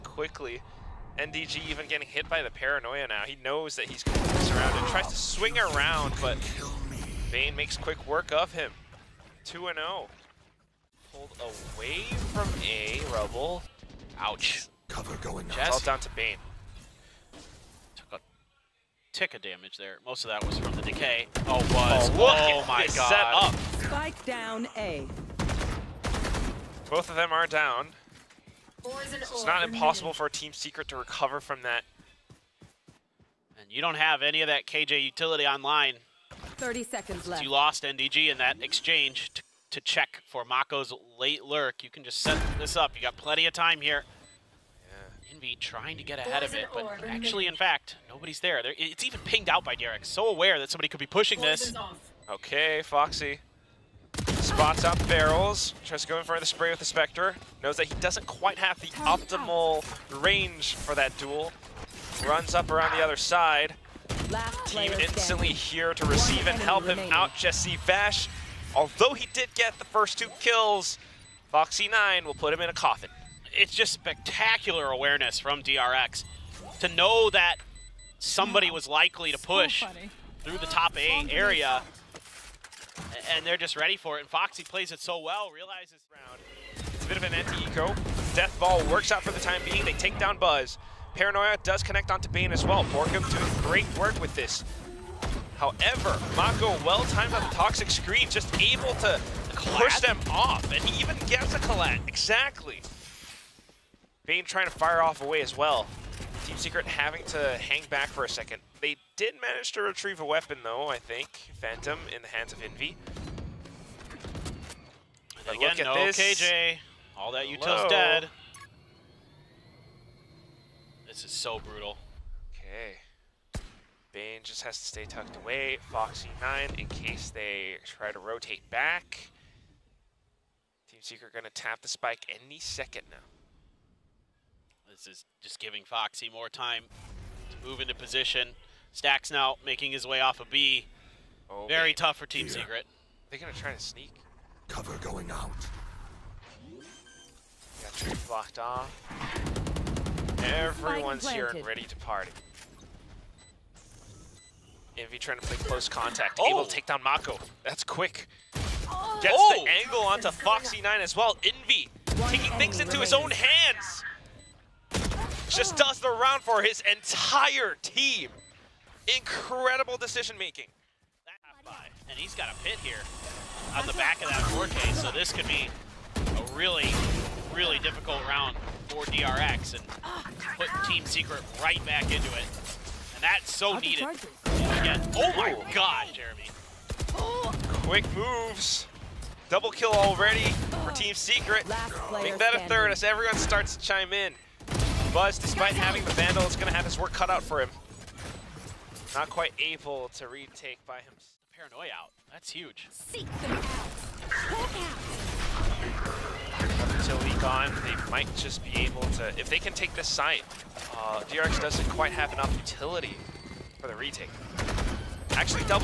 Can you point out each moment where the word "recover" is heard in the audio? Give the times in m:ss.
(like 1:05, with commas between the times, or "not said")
0:30.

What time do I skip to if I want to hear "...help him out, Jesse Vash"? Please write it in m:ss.
1:06.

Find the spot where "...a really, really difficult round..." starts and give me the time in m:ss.
2:56.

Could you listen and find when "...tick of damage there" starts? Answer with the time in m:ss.
0:19.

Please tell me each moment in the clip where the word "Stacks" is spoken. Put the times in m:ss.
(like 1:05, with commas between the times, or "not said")
2:18.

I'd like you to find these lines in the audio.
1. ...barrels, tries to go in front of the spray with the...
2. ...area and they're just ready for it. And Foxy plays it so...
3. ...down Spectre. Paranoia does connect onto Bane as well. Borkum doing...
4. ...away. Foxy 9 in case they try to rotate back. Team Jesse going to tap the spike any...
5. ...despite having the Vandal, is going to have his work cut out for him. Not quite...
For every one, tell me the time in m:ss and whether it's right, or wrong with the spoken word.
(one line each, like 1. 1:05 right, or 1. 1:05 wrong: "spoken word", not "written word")
1. 0:55 right
2. 1:21 right
3. 1:30 wrong: "Buzz", not "Spectre"
4. 2:05 wrong: "Secret", not "Jesse"
5. 3:15 right.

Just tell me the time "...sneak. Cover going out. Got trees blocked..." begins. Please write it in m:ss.
2:23.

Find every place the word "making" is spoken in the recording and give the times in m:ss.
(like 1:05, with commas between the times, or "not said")
2:19, 2:50.